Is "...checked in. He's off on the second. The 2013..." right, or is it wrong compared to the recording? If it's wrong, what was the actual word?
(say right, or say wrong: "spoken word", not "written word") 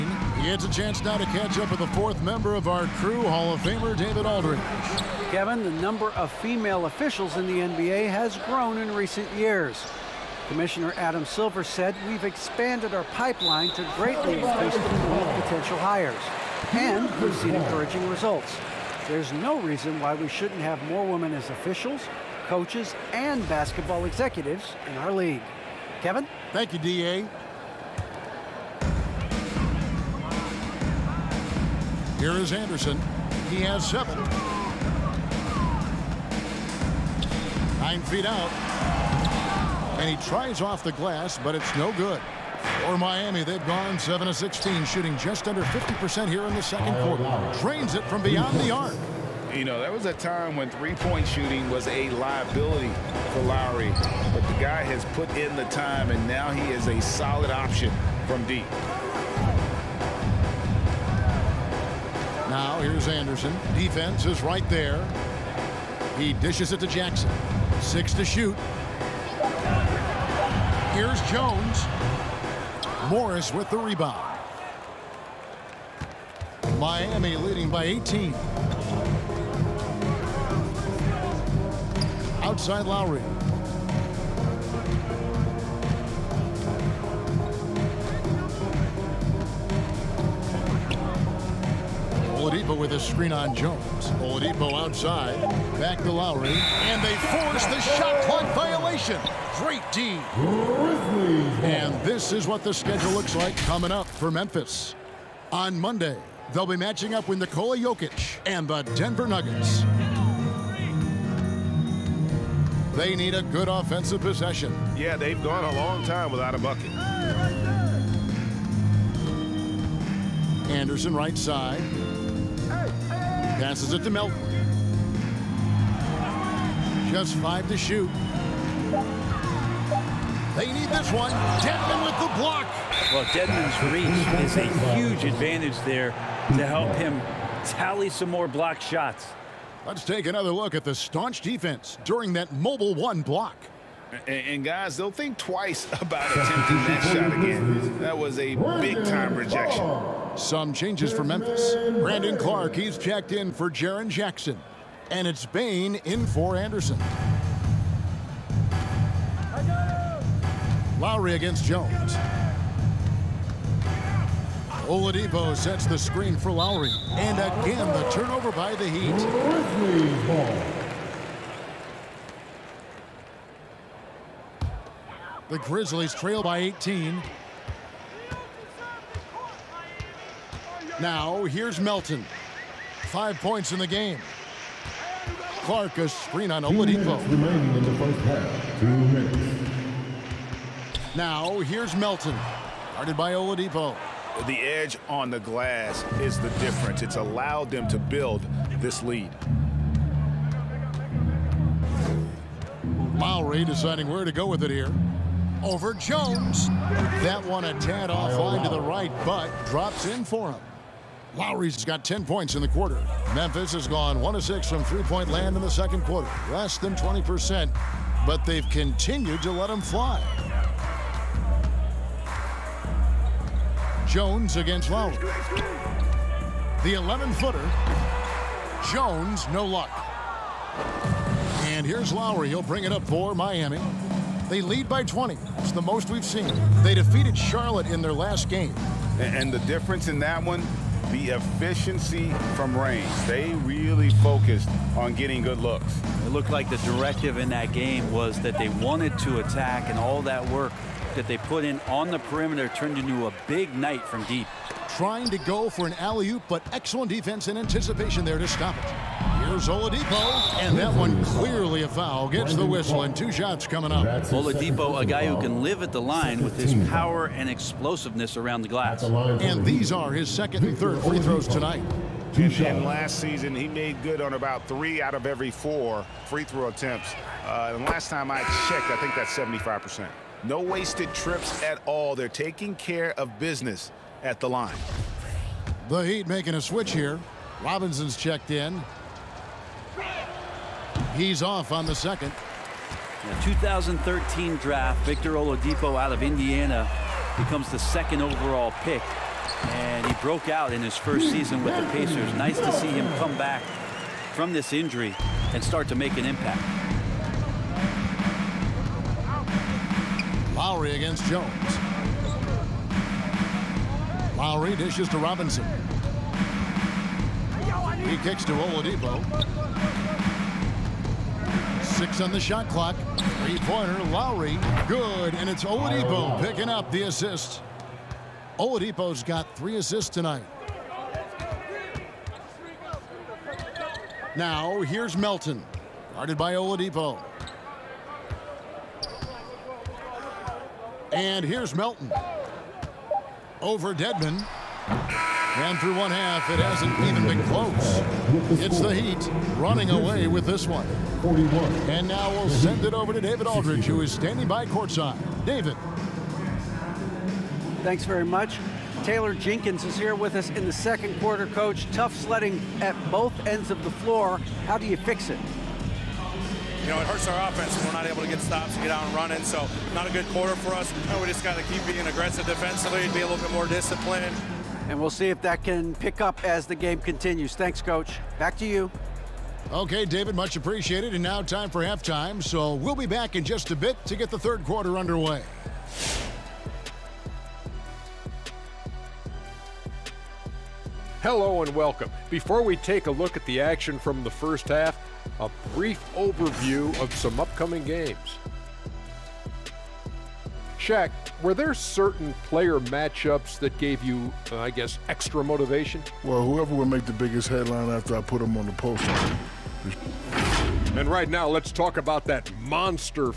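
right.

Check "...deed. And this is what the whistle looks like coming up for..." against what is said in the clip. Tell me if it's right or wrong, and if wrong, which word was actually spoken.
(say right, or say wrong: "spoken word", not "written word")
wrong: "schedule", not "whistle".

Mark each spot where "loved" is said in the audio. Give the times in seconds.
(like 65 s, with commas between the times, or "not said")
not said.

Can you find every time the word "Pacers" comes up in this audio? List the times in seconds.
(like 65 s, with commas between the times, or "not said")
301 s.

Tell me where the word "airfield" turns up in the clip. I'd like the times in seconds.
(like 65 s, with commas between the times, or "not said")
not said.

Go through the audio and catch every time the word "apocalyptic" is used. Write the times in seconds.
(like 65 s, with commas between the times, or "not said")
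not said.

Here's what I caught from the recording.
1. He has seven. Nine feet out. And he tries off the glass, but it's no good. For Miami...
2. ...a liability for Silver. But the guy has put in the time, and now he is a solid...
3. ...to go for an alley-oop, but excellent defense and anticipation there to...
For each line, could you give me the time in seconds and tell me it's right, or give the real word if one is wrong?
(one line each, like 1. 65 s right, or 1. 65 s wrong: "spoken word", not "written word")
1. 33 s right
2. 51 s wrong: "Lowry", not "Silver"
3. 255 s right.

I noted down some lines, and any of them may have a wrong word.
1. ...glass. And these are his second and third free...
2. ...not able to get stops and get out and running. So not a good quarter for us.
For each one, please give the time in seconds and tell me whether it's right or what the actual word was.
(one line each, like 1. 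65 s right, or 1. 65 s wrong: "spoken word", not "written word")
1. 268 s right
2. 367 s right.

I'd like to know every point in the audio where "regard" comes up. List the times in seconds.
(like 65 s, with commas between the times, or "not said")
not said.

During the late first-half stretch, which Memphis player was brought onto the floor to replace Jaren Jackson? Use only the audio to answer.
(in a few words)
Brandon Clarke.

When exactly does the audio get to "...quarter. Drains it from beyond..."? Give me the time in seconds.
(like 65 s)
47 s.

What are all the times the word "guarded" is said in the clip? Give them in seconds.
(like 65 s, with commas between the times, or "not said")
192 s, 336 s.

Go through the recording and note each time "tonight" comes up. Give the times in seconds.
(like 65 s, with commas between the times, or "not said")
271 s, 330 s.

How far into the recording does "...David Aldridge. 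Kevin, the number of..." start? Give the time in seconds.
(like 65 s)
3 s.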